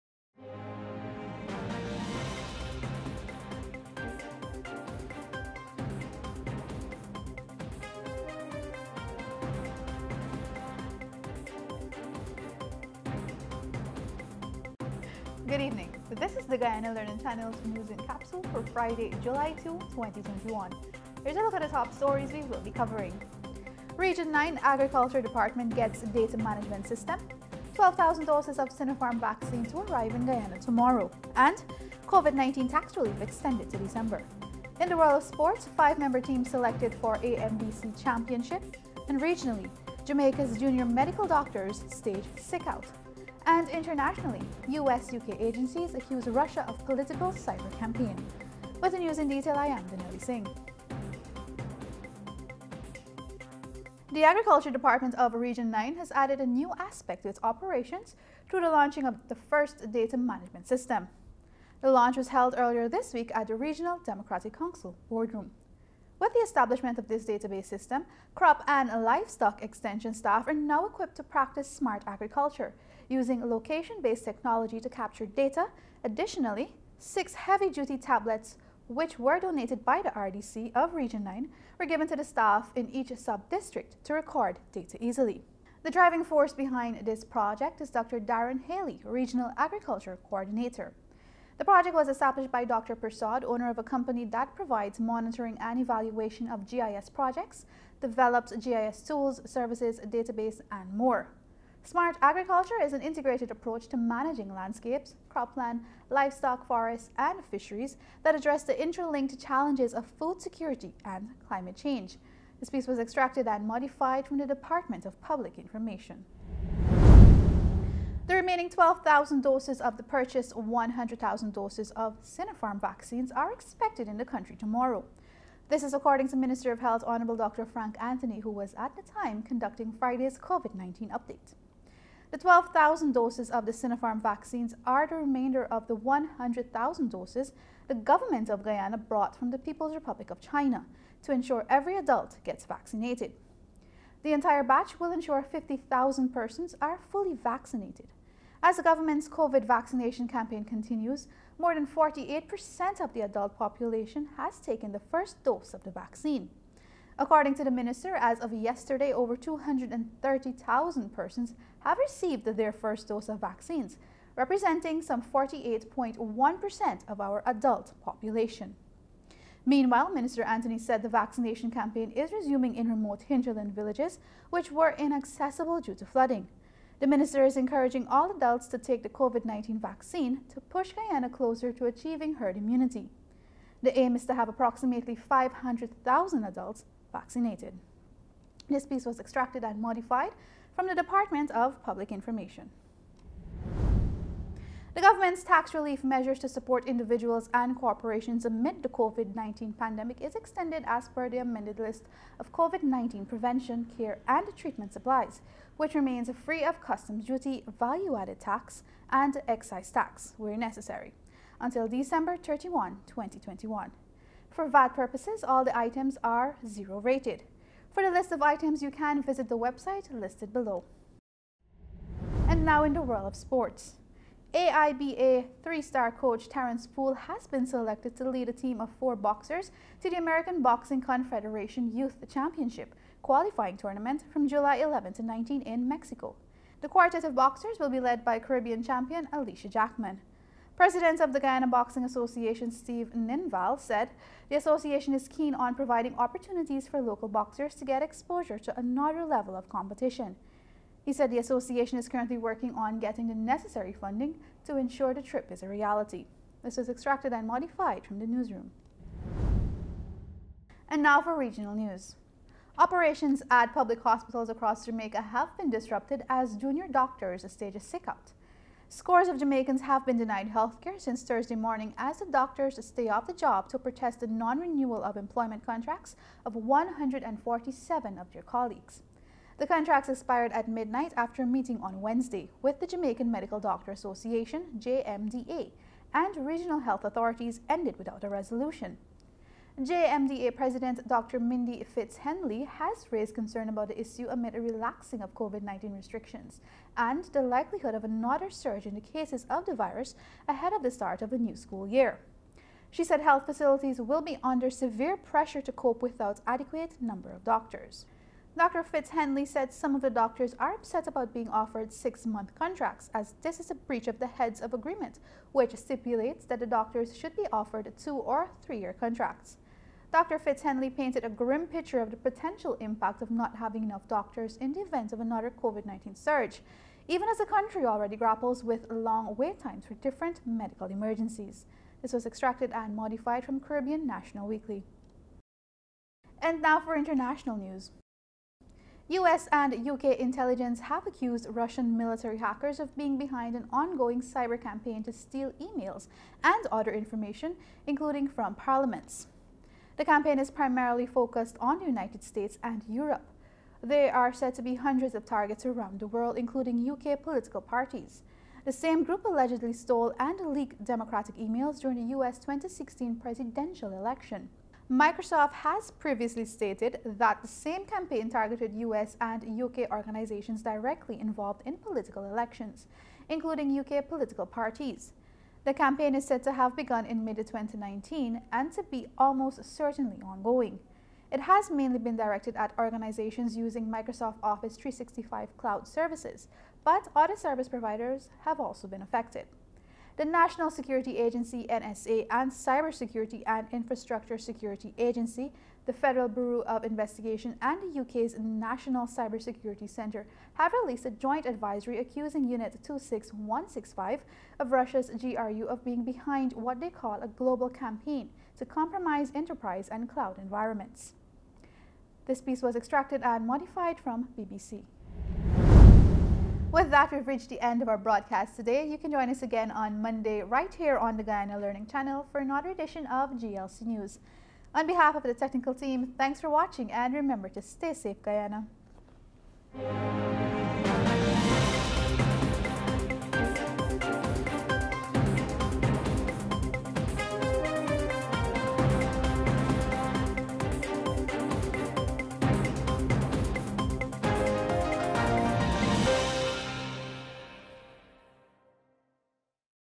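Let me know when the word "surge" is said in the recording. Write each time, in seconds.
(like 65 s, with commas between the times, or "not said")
298 s, 326 s.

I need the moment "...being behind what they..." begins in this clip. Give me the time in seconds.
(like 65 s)
405 s.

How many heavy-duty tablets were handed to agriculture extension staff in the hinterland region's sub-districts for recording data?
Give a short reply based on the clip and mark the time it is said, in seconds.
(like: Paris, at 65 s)
6, at 76 s.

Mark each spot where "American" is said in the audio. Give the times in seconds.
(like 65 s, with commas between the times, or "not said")
230 s.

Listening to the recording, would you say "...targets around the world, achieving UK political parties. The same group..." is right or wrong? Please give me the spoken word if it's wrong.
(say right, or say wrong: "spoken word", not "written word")
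wrong: "including", not "achieving".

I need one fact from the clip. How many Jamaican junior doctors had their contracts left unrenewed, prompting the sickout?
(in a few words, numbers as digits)
147.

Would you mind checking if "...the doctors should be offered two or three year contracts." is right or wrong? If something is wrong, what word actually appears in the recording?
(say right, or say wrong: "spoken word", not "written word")
right.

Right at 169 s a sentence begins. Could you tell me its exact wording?
Meanwhile, Minister Anthony said the vaccination campaign is resuming in remote hinterland villages, which were inaccessible due to flooding.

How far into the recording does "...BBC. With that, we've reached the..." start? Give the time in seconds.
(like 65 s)
414 s.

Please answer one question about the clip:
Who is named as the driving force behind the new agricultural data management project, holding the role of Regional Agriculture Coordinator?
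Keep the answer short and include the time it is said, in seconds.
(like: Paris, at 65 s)
Dr. Darren Haley, at 87 s.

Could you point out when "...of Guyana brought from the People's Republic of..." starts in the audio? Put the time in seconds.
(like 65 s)
138 s.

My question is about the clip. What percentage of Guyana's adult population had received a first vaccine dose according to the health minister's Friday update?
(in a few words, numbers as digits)
48.1%.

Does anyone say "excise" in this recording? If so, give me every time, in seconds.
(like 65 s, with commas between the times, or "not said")
209 s.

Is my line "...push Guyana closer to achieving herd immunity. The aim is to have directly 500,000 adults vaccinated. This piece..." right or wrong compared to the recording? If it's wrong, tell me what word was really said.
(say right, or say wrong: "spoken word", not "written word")
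wrong: "approximately", not "directly".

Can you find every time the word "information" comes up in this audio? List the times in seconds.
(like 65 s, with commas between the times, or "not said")
115 s, 192 s, 346 s.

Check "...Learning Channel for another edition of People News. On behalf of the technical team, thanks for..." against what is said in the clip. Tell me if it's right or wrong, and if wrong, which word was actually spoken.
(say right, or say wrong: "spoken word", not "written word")
wrong: "GLC", not "People".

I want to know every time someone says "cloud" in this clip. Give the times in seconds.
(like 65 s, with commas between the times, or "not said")
385 s, 410 s.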